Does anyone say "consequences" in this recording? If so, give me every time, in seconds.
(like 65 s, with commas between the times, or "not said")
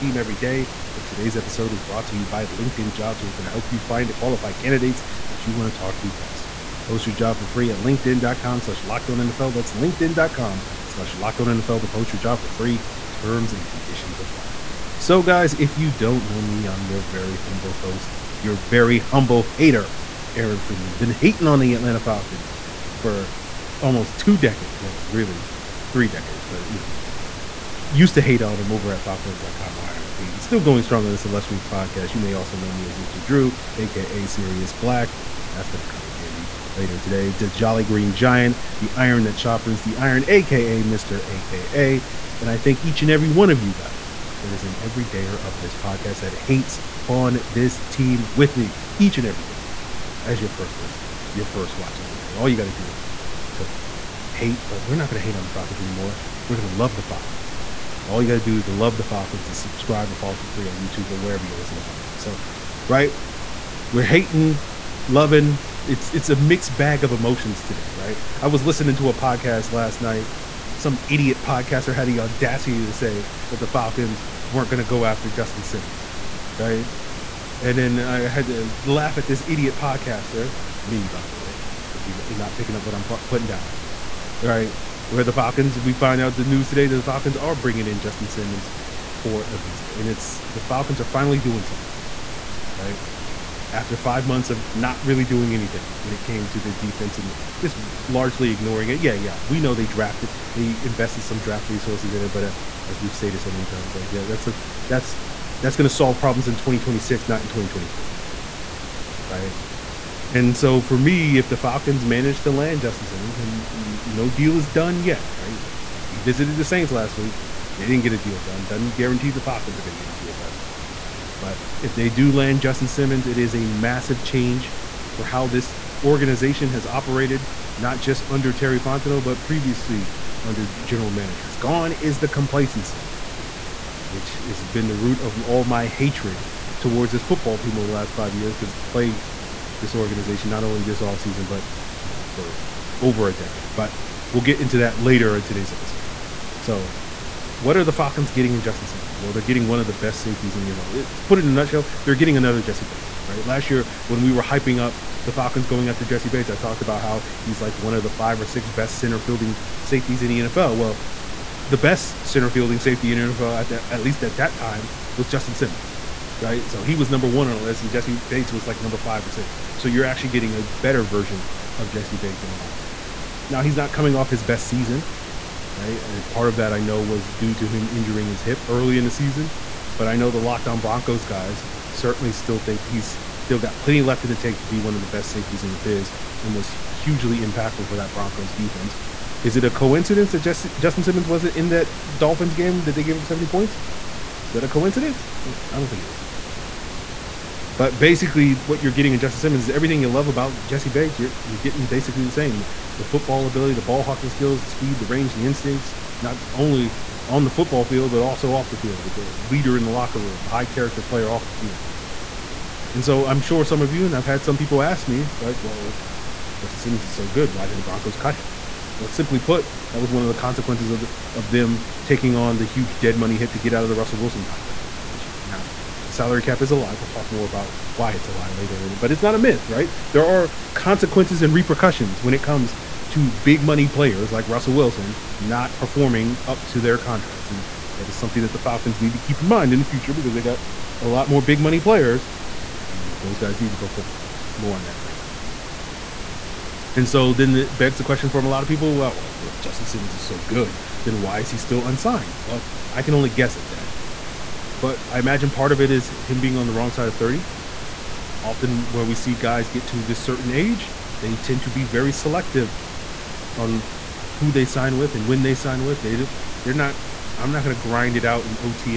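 220 s, 230 s.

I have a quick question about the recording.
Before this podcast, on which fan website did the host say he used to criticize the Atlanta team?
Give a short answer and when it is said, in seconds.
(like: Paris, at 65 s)
FalcFans.com, at 29 s.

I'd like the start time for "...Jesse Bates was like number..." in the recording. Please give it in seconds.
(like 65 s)
167 s.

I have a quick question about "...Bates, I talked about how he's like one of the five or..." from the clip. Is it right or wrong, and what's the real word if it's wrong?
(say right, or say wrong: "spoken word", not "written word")
right.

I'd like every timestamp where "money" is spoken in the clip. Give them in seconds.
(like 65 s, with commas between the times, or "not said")
223 s, 233 s, 241 s.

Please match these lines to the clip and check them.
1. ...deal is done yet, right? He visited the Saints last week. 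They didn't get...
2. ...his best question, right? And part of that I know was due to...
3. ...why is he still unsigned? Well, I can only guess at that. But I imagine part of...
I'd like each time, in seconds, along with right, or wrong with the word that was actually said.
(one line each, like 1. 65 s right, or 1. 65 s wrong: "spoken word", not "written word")
1. 114 s right
2. 174 s wrong: "season", not "question"
3. 251 s right.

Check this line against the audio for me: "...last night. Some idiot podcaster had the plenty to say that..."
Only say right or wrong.
wrong.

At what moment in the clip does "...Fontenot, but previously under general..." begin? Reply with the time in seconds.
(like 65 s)
128 s.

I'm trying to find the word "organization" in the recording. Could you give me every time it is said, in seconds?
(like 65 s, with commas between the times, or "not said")
126 s, 139 s.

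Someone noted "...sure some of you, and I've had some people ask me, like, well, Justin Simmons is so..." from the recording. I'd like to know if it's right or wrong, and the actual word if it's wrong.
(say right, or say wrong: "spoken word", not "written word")
right.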